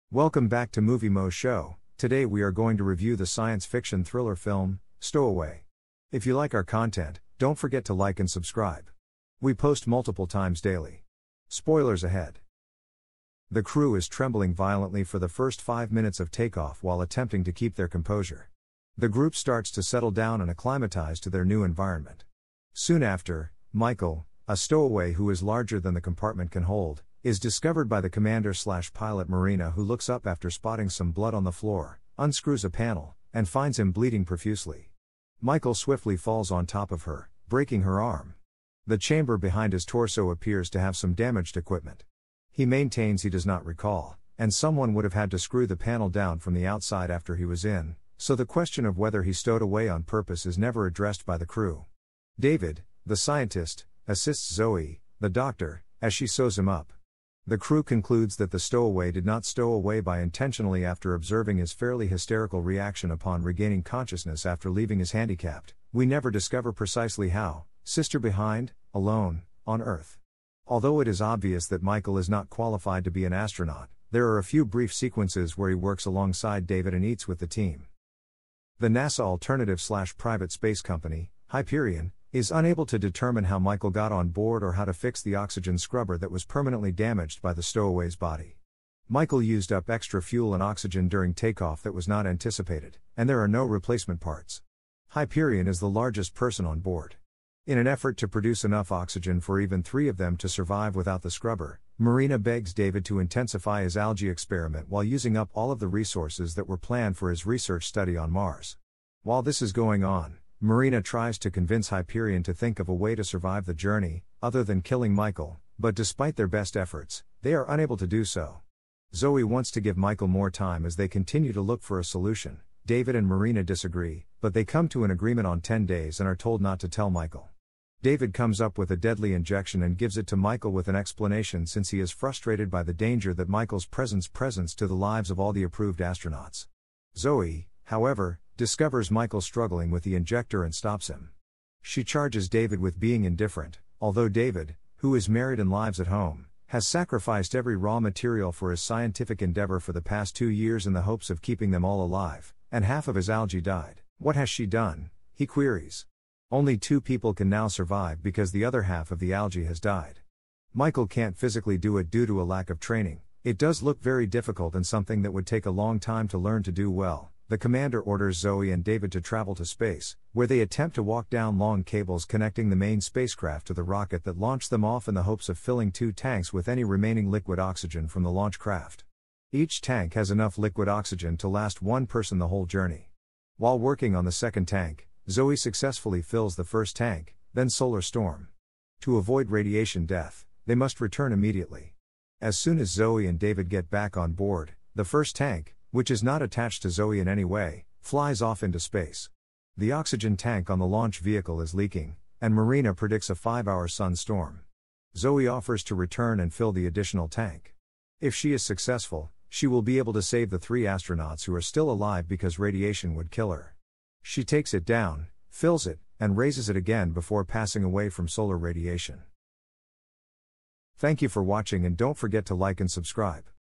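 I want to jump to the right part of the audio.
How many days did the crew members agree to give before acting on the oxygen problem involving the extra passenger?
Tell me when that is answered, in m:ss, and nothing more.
2:05.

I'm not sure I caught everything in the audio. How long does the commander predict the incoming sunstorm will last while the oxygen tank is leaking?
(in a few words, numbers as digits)
5 hours.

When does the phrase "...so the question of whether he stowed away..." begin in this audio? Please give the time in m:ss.
0:48.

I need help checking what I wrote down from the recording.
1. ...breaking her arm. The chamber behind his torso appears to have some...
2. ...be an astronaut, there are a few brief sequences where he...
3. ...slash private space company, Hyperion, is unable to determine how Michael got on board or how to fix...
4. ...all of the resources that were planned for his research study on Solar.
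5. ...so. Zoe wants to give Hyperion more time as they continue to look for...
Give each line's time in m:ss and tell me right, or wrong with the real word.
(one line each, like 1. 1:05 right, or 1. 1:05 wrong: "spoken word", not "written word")
1. 0:37 right
2. 1:13 right
3. 1:19 right
4. 1:45 wrong: "Mars", not "Solar"
5. 1:58 wrong: "Michael", not "Hyperion".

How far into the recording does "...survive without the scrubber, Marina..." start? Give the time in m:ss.
1:40.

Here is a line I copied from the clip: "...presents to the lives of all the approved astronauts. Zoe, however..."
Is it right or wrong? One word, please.
right.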